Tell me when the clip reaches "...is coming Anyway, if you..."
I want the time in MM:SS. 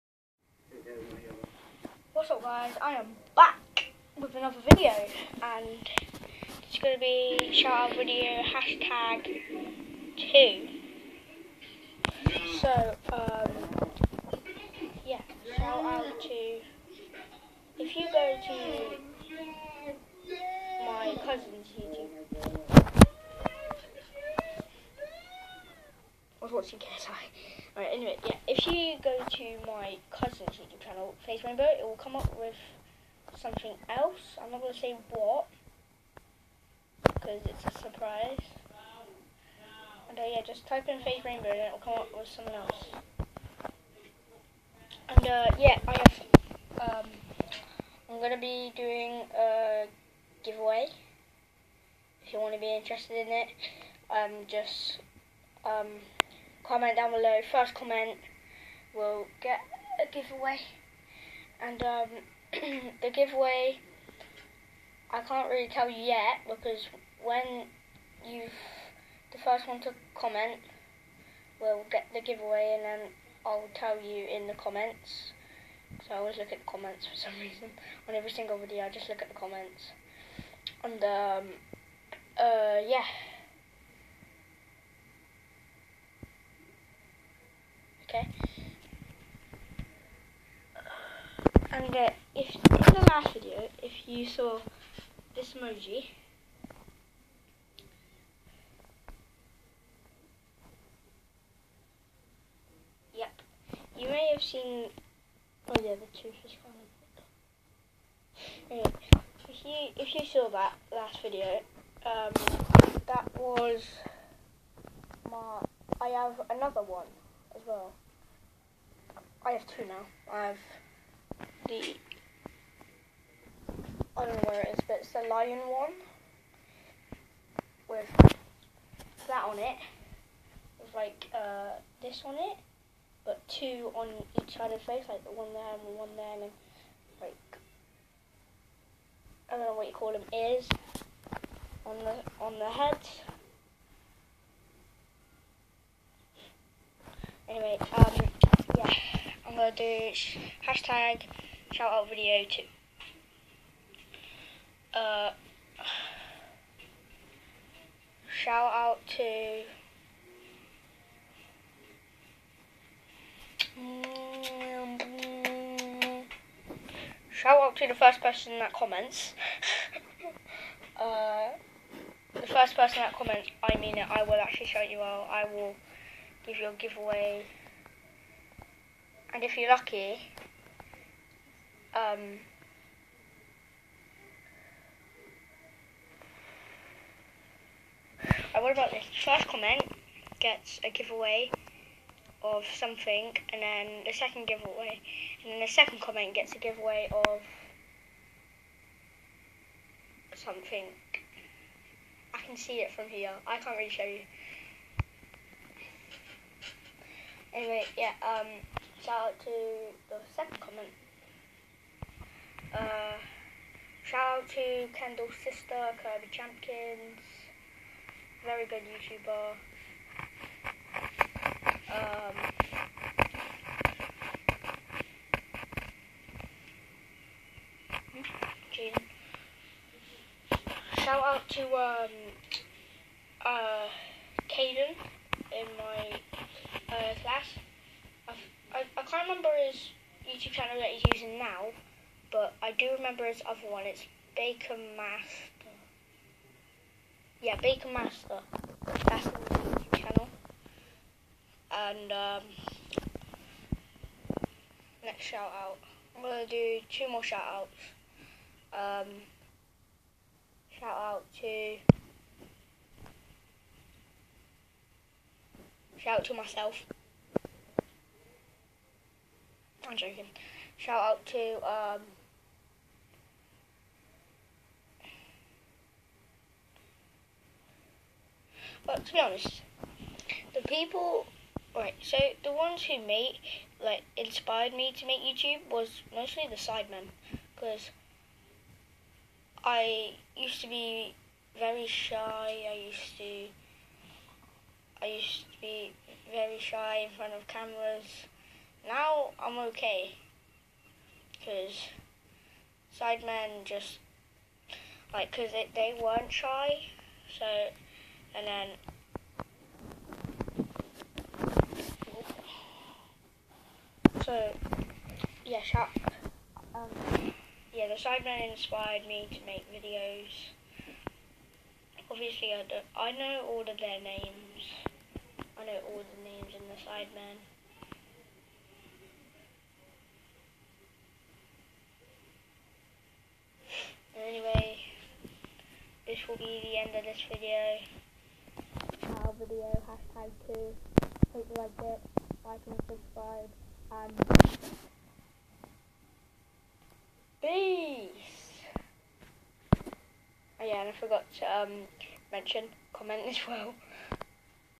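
01:46.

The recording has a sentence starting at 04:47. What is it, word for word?
Because I used to be very shy, I used to, I used to be very shy in front of cameras.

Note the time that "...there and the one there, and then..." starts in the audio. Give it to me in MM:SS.
02:15.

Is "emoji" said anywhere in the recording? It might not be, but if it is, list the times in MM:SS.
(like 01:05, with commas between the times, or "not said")
01:35.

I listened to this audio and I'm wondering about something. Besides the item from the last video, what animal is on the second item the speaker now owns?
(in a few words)
Lion.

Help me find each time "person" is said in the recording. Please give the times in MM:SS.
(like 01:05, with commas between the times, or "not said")
02:48, 02:52.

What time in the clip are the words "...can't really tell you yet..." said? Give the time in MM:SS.
01:05.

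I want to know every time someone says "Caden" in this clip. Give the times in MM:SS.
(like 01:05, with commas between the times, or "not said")
03:54.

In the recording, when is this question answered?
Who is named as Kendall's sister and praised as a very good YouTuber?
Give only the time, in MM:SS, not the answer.
03:36.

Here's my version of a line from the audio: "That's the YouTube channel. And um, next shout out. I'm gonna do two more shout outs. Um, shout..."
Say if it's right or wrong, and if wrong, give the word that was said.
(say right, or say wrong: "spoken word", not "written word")
right.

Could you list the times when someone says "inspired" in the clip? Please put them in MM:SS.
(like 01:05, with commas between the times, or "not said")
04:44, 05:18.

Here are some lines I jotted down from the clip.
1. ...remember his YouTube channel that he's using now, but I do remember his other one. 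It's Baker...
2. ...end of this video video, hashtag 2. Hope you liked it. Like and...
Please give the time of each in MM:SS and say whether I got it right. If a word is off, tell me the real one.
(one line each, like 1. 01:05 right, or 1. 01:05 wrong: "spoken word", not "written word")
1. 03:59 right
2. 05:36 right.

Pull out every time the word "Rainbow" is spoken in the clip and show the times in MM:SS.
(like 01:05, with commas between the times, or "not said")
00:31, 00:41.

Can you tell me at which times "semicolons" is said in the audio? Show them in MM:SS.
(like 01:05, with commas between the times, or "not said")
not said.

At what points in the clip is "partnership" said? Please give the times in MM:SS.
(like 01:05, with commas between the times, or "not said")
not said.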